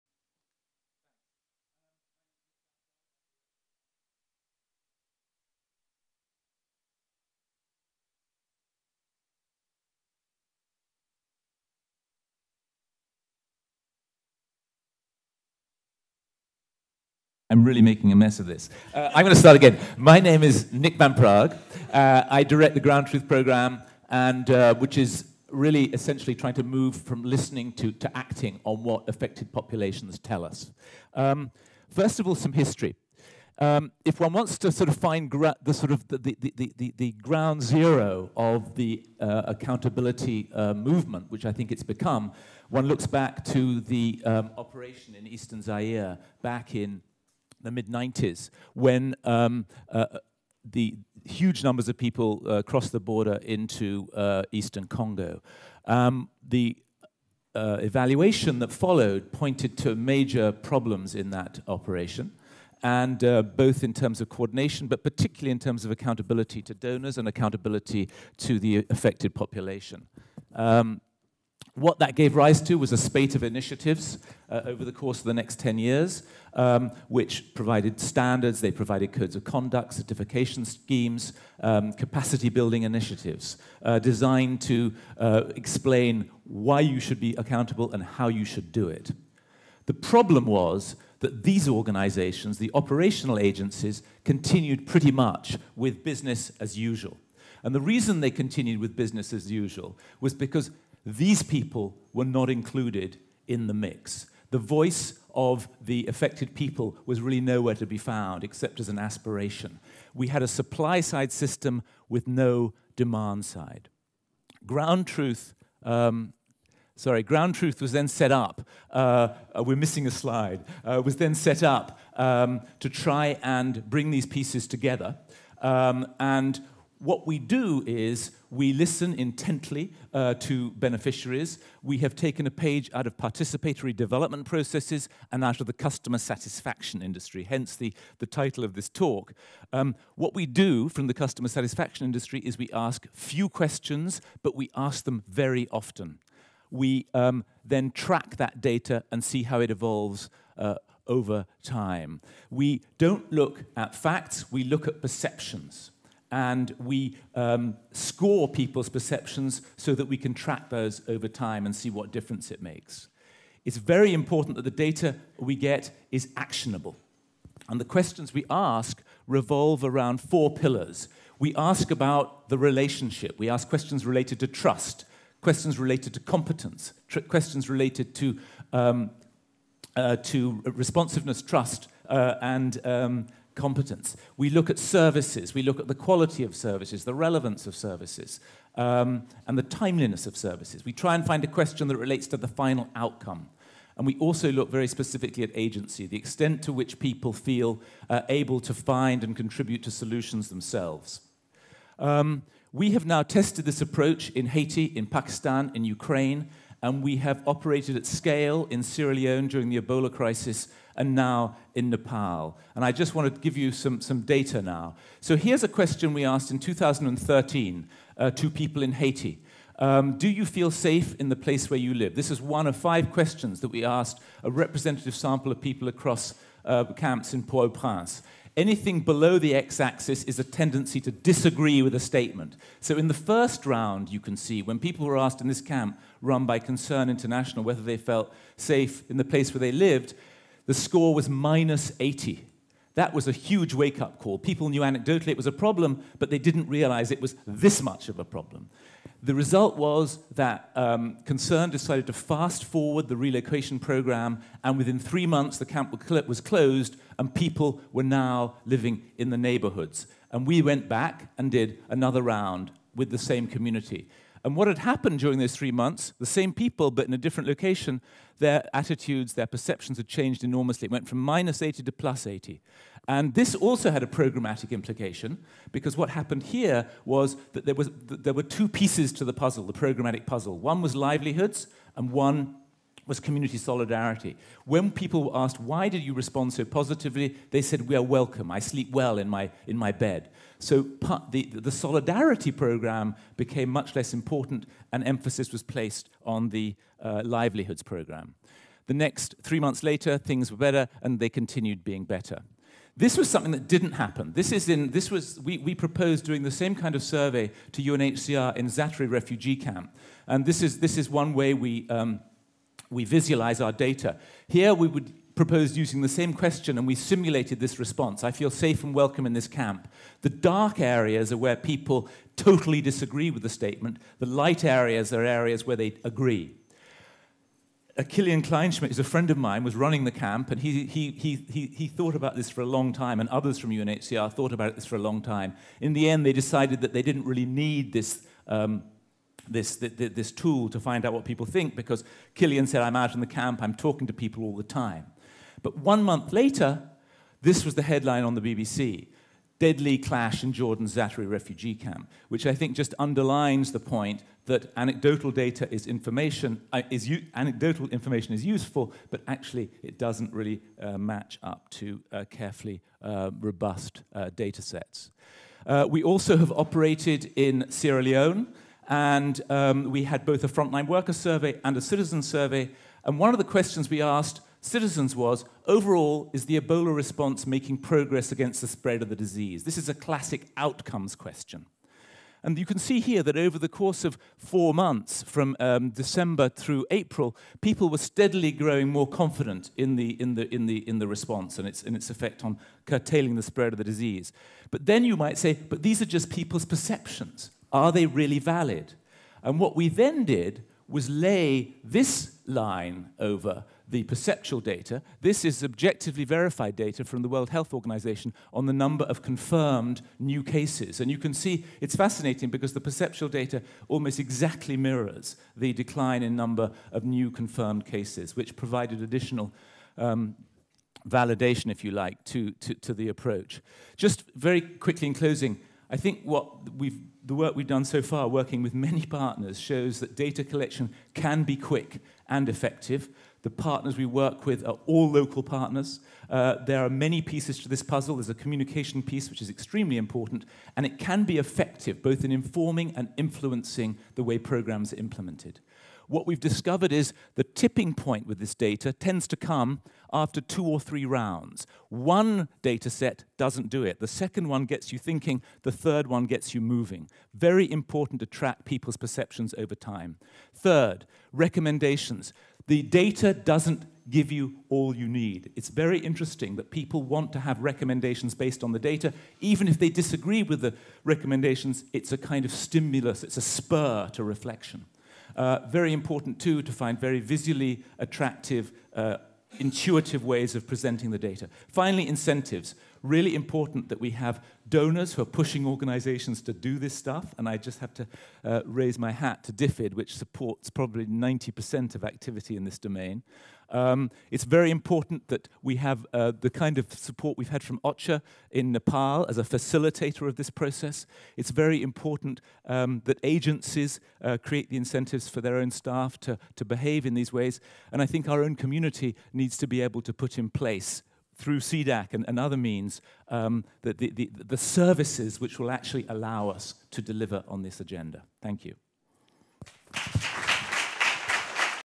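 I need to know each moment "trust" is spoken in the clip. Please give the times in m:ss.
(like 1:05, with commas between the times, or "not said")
2:54, 3:01.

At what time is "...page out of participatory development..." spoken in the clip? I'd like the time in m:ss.
2:12.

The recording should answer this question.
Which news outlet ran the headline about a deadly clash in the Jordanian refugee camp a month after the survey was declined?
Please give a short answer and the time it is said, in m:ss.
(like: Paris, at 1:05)
BBC, at 5:48.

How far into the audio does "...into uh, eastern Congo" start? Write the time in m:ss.
0:53.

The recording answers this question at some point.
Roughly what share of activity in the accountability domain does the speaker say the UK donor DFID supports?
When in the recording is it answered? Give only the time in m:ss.
8:11.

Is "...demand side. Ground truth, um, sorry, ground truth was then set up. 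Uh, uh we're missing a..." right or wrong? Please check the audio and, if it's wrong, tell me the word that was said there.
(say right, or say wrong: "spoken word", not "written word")
right.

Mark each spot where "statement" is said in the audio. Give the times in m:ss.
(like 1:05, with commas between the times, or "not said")
3:52, 5:23.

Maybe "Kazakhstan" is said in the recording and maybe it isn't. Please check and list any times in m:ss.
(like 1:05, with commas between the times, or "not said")
not said.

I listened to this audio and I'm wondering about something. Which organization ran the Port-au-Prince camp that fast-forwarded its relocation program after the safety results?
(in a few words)
Concern International.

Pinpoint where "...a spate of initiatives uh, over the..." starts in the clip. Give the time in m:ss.
1:12.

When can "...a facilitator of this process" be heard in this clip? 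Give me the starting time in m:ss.
8:19.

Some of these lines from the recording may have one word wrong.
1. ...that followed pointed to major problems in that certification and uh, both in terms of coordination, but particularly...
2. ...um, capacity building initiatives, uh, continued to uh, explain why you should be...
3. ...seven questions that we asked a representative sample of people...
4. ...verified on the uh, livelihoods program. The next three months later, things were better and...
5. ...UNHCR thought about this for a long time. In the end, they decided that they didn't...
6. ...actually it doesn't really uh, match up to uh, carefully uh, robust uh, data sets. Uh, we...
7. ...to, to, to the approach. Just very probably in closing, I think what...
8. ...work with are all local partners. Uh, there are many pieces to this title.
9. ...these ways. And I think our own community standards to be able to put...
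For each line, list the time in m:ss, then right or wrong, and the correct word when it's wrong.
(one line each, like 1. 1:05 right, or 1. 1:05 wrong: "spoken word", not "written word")
1. 0:58 wrong: "operation", not "certification"
2. 1:21 wrong: "designed", not "continued"
3. 3:42 wrong: "five", not "seven"
4. 4:55 wrong: "placed", not "verified"
5. 5:33 right
6. 5:59 right
7. 7:02 wrong: "quickly", not "probably"
8. 7:14 wrong: "puzzle", not "title"
9. 8:27 wrong: "needs", not "standards".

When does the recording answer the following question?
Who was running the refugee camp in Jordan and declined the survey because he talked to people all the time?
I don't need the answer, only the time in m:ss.
5:28.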